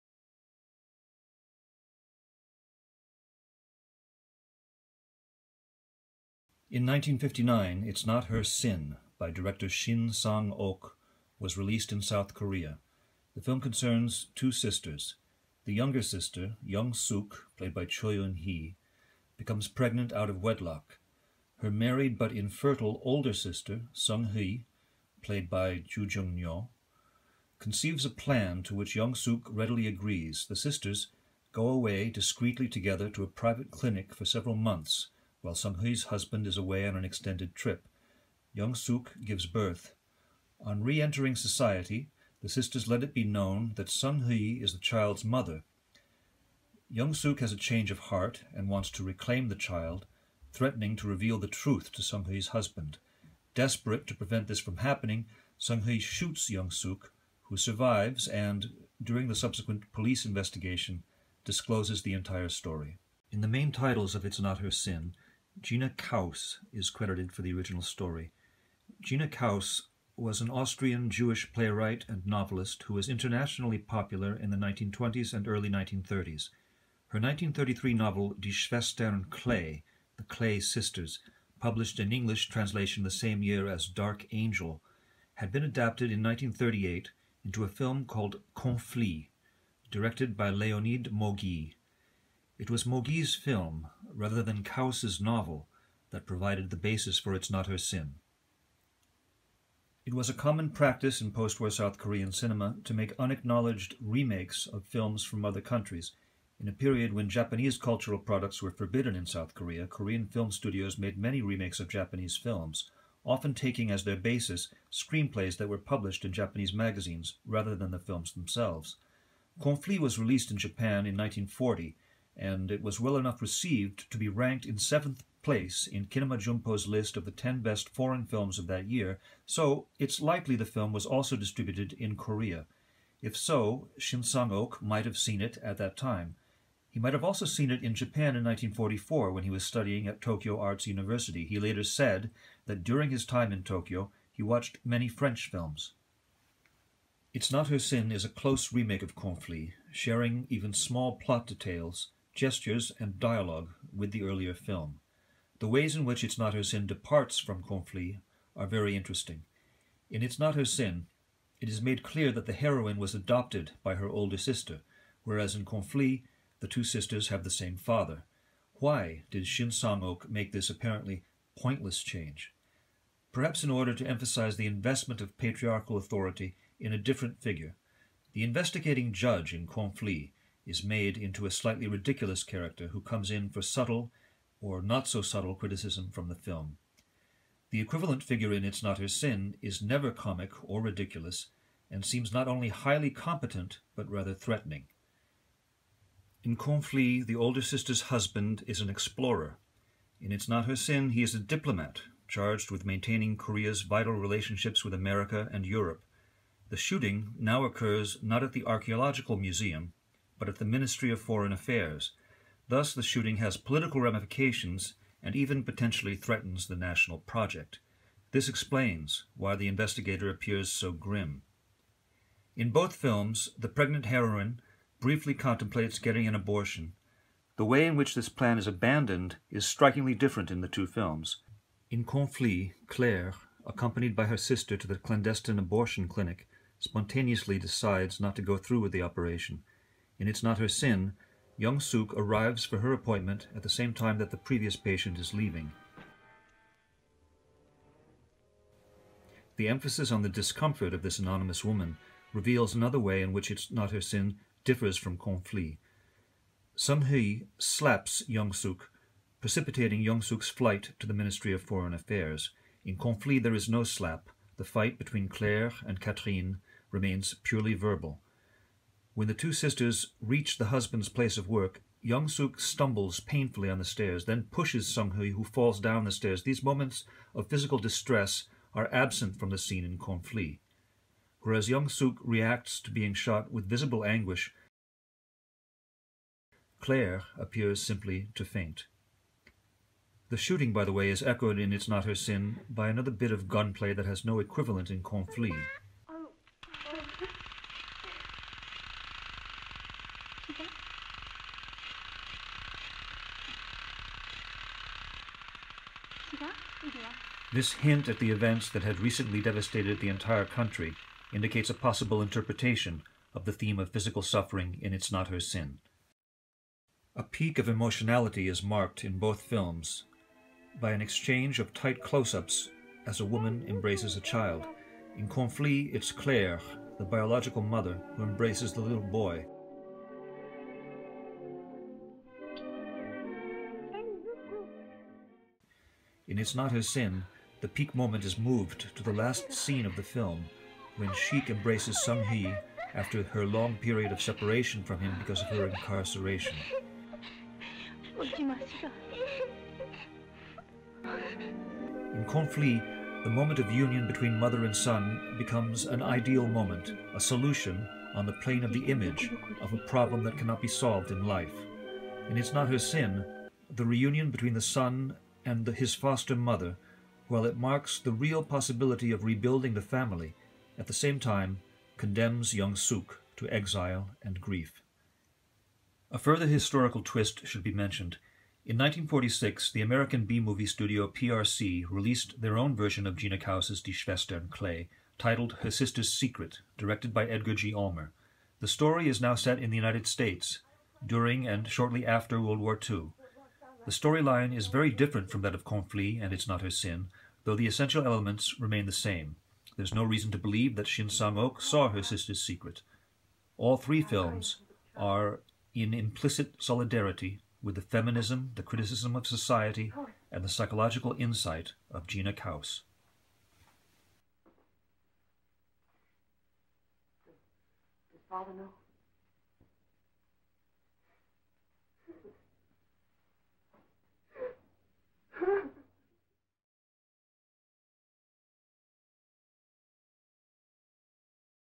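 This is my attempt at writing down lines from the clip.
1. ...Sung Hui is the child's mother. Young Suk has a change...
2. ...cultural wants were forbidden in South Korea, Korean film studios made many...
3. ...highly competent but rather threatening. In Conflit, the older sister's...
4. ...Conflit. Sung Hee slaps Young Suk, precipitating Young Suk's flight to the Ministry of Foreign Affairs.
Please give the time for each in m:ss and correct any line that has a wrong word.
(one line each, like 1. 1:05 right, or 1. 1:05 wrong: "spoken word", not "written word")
1. 0:43 right
2. 1:47 wrong: "products", not "wants"
3. 3:12 right
4. 4:15 right.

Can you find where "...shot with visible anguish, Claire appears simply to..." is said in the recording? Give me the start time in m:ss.
4:43.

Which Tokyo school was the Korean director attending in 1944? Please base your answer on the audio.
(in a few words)
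Tokyo Arts University.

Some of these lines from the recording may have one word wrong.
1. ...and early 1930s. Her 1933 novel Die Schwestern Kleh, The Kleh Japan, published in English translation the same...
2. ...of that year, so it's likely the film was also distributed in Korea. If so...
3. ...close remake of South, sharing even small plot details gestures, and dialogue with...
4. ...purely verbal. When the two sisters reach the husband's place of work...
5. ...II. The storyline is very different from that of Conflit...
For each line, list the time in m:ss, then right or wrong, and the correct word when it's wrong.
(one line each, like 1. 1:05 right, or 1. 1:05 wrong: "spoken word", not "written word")
1. 1:15 wrong: "Sisters", not "Japan"
2. 2:08 right
3. 2:28 wrong: "Conflit", not "South"
4. 4:27 right
5. 6:32 right.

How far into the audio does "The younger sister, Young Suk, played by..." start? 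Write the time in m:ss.
0:15.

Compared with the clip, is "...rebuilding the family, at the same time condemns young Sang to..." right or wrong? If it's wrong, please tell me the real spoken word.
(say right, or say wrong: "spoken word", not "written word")
wrong: "Suk", not "Sang".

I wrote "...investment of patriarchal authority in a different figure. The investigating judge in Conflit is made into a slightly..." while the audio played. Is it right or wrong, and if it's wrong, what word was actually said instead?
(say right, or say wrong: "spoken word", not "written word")
right.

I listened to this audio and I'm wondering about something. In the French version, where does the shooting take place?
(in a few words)
Archaeological Museum.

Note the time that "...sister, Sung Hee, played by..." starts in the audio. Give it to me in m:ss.
0:23.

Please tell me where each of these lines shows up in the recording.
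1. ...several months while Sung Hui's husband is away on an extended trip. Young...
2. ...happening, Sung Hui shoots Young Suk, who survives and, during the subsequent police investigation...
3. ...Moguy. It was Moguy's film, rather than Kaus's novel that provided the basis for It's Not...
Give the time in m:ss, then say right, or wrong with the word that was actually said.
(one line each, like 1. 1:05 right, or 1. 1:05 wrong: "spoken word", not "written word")
1. 0:34 right
2. 0:54 right
3. 1:31 right.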